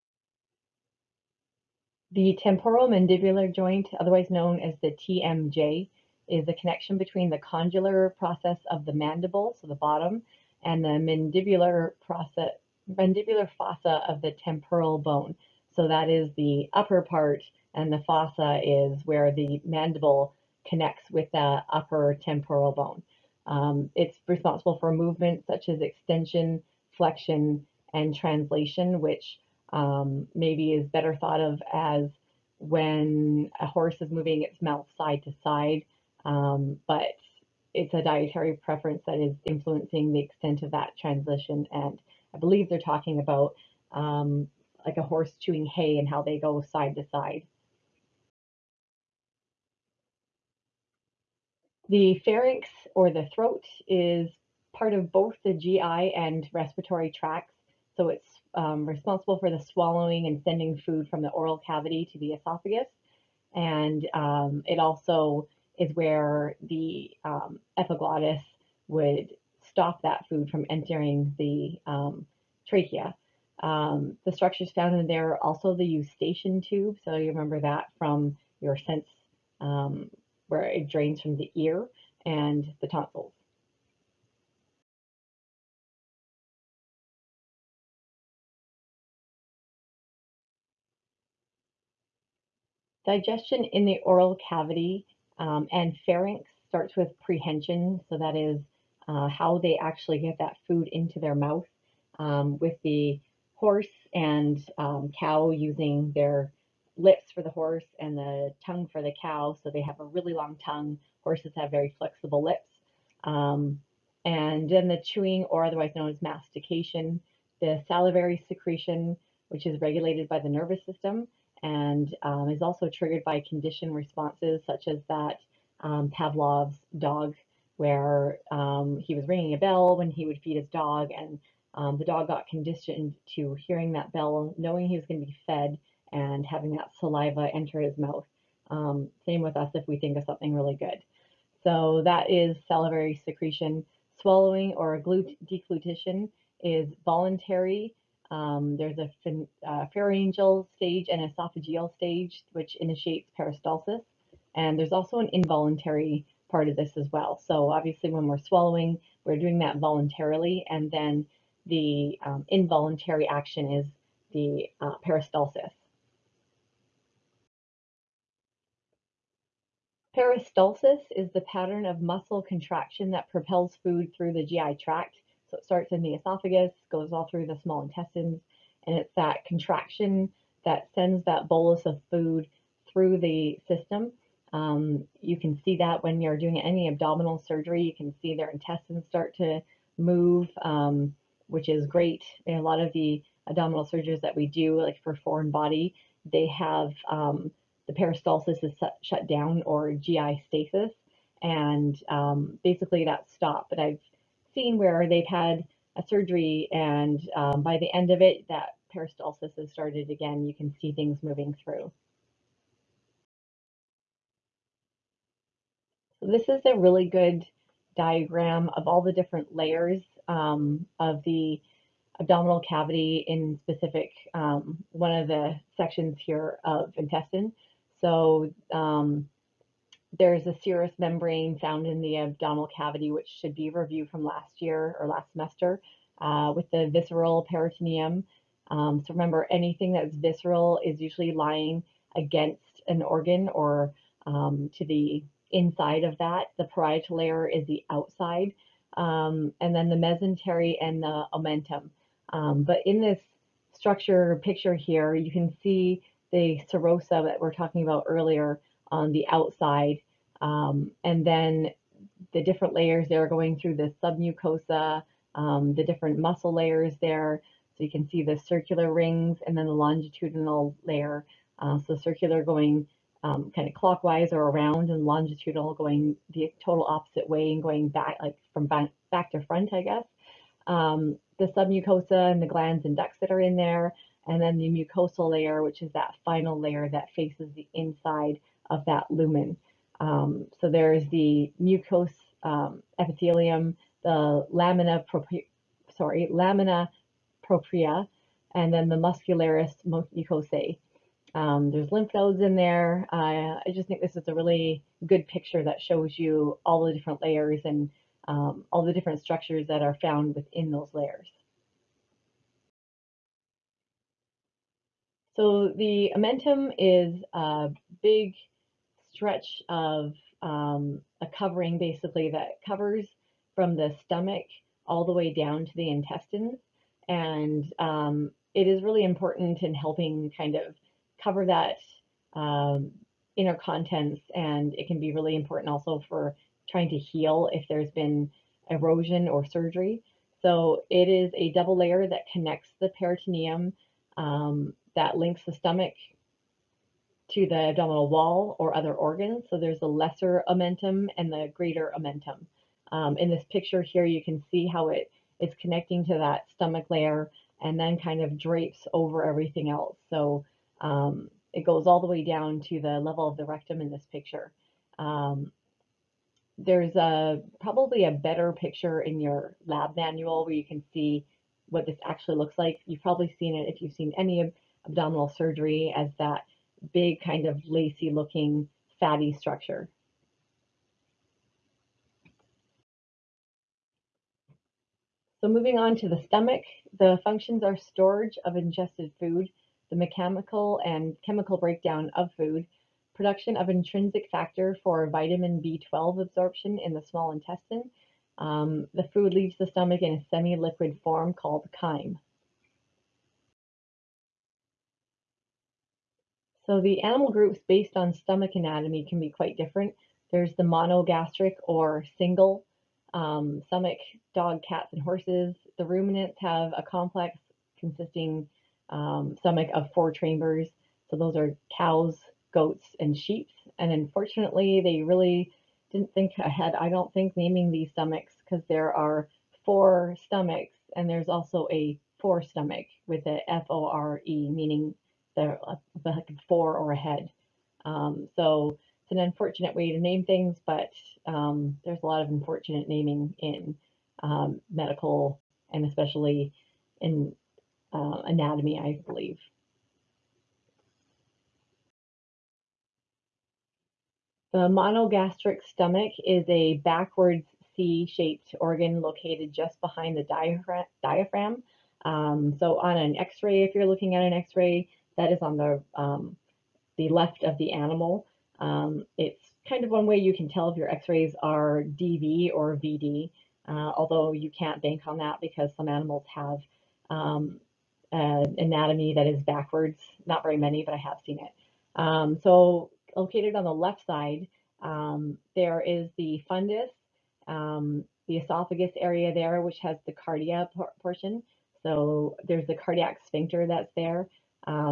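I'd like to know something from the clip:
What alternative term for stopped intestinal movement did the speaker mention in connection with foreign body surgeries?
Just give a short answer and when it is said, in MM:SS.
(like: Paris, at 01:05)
GI stasis, at 03:19.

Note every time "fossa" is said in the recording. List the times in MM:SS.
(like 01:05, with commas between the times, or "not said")
00:13, 00:17.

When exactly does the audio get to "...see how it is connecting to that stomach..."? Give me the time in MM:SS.
05:54.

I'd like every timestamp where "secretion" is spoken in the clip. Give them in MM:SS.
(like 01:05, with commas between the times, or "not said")
01:58, 02:23.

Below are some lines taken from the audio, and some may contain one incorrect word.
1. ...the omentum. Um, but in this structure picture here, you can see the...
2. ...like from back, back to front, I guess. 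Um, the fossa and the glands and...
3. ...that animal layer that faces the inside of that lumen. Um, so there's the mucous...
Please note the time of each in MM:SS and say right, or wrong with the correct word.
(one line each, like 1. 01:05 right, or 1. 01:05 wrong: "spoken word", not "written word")
1. 04:11 right
2. 04:38 wrong: "submucosa", not "fossa"
3. 04:45 wrong: "final", not "animal".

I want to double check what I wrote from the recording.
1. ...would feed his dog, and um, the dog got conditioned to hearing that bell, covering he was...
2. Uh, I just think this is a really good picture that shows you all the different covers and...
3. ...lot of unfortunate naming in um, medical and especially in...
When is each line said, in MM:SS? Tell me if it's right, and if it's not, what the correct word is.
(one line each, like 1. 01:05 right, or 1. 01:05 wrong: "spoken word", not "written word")
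1. 02:10 wrong: "knowing", not "covering"
2. 05:03 wrong: "layers", not "covers"
3. 07:22 right.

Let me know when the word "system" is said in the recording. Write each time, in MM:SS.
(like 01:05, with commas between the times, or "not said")
02:00, 03:03.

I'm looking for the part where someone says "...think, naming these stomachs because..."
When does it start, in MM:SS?
07:07.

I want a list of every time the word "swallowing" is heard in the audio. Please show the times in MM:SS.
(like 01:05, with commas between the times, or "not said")
00:59, 02:24, 02:38.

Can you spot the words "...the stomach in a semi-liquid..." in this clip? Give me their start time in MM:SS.
06:39.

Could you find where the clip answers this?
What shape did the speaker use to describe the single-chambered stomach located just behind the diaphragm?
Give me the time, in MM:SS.
07:36.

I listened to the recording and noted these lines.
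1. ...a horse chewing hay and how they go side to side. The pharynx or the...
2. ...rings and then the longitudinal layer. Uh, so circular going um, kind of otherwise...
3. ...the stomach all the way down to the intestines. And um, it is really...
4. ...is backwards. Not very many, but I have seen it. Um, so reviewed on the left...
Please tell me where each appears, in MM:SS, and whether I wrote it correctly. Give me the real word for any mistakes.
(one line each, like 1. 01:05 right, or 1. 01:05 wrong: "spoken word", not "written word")
1. 00:44 right
2. 04:28 wrong: "clockwise", not "otherwise"
3. 05:23 right
4. 07:59 wrong: "located", not "reviewed".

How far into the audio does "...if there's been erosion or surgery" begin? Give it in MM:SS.
05:37.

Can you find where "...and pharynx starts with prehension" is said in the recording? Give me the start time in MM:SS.
01:35.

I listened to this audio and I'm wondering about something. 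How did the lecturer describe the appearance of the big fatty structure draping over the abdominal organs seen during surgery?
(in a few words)
lacy looking.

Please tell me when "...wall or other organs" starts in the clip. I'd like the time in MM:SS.
05:48.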